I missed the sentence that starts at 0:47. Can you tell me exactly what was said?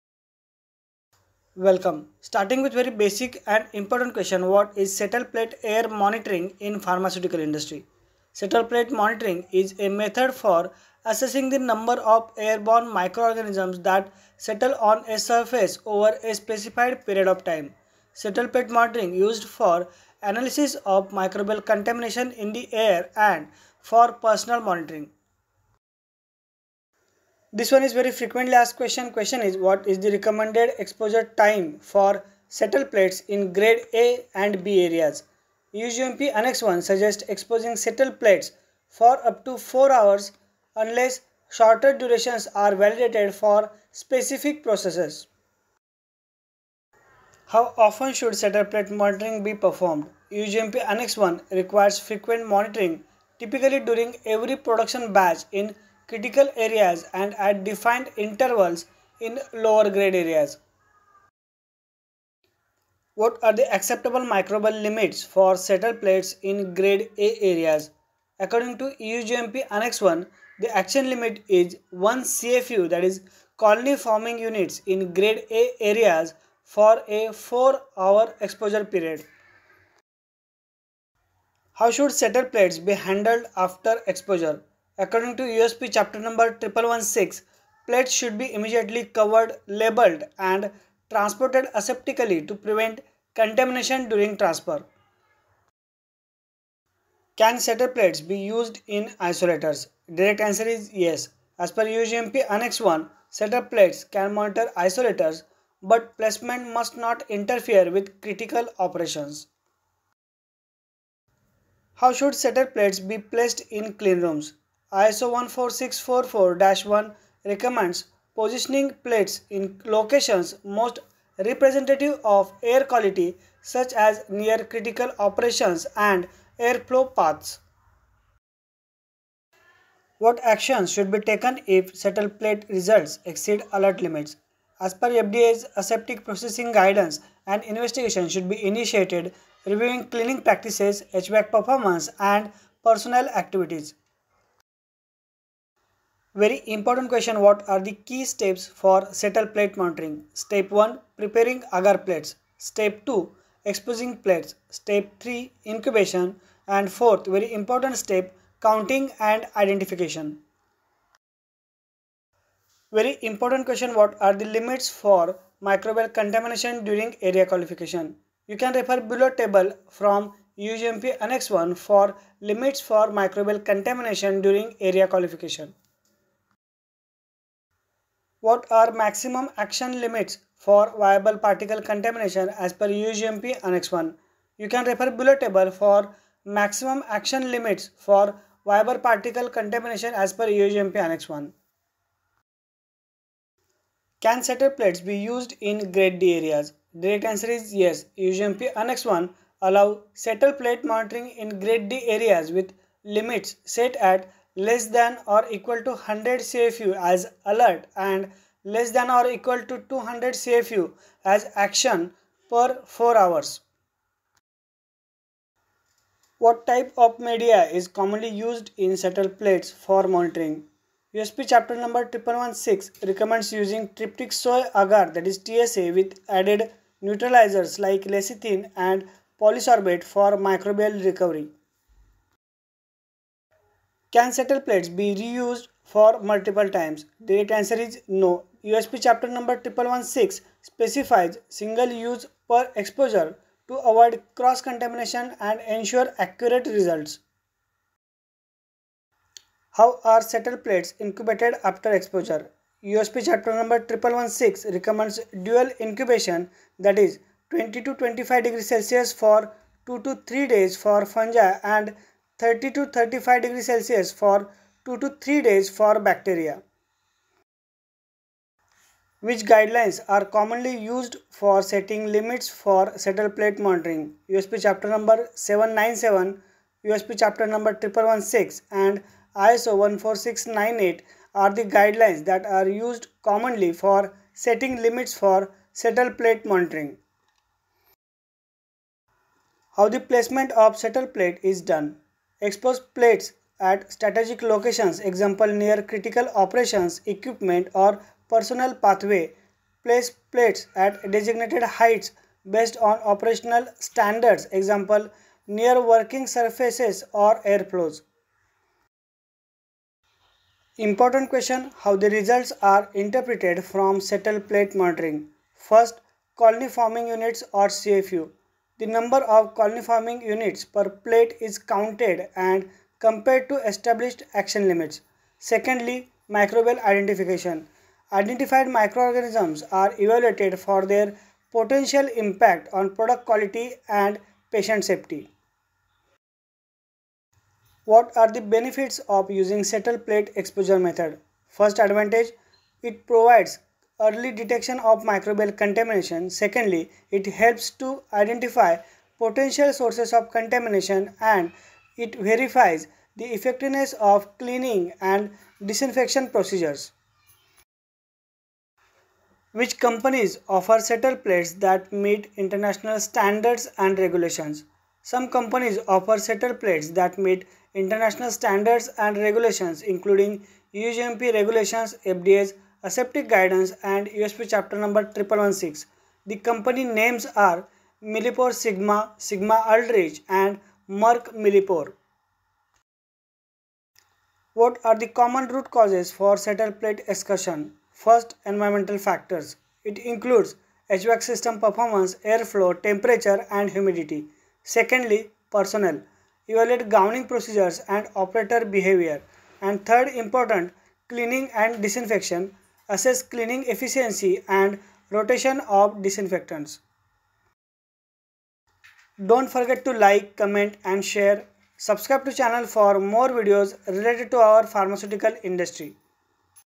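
How often should settle plate monitoring be performed?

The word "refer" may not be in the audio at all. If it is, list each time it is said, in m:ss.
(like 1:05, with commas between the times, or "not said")
2:48, 3:04.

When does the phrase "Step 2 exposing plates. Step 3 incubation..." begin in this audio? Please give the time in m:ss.
2:32.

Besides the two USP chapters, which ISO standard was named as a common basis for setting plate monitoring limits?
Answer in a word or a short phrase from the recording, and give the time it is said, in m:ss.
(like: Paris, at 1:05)
ISO 14698, at 4:39.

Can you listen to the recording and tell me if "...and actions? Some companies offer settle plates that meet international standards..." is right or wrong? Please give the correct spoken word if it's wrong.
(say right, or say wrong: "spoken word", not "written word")
wrong: "regulations", not "actions".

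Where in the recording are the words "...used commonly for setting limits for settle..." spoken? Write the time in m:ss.
4:42.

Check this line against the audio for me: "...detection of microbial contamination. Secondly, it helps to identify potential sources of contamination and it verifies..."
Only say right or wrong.
right.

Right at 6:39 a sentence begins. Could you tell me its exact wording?
And third important, cleaning and disinfection assess cleaning efficiency and rotation of disinfectants.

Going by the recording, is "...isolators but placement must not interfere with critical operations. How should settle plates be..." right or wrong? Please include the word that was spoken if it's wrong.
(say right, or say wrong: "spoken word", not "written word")
right.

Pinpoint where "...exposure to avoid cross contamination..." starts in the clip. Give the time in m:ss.
4:02.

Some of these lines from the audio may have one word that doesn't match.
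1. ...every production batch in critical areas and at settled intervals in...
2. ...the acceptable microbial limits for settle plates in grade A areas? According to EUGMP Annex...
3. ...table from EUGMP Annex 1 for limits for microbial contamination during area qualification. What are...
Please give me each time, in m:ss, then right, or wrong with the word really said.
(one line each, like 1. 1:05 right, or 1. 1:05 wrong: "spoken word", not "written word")
1. 0:54 wrong: "defined", not "settled"
2. 1:03 right
3. 2:49 right.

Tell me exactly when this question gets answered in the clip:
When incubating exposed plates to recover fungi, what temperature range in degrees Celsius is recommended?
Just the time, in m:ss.
4:17.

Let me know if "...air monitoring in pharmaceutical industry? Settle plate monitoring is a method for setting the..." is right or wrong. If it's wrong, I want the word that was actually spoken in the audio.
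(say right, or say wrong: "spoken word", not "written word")
wrong: "assessing", not "setting".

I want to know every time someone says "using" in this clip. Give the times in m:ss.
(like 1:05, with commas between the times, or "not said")
3:43, 5:39.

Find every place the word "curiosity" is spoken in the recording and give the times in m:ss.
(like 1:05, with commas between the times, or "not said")
not said.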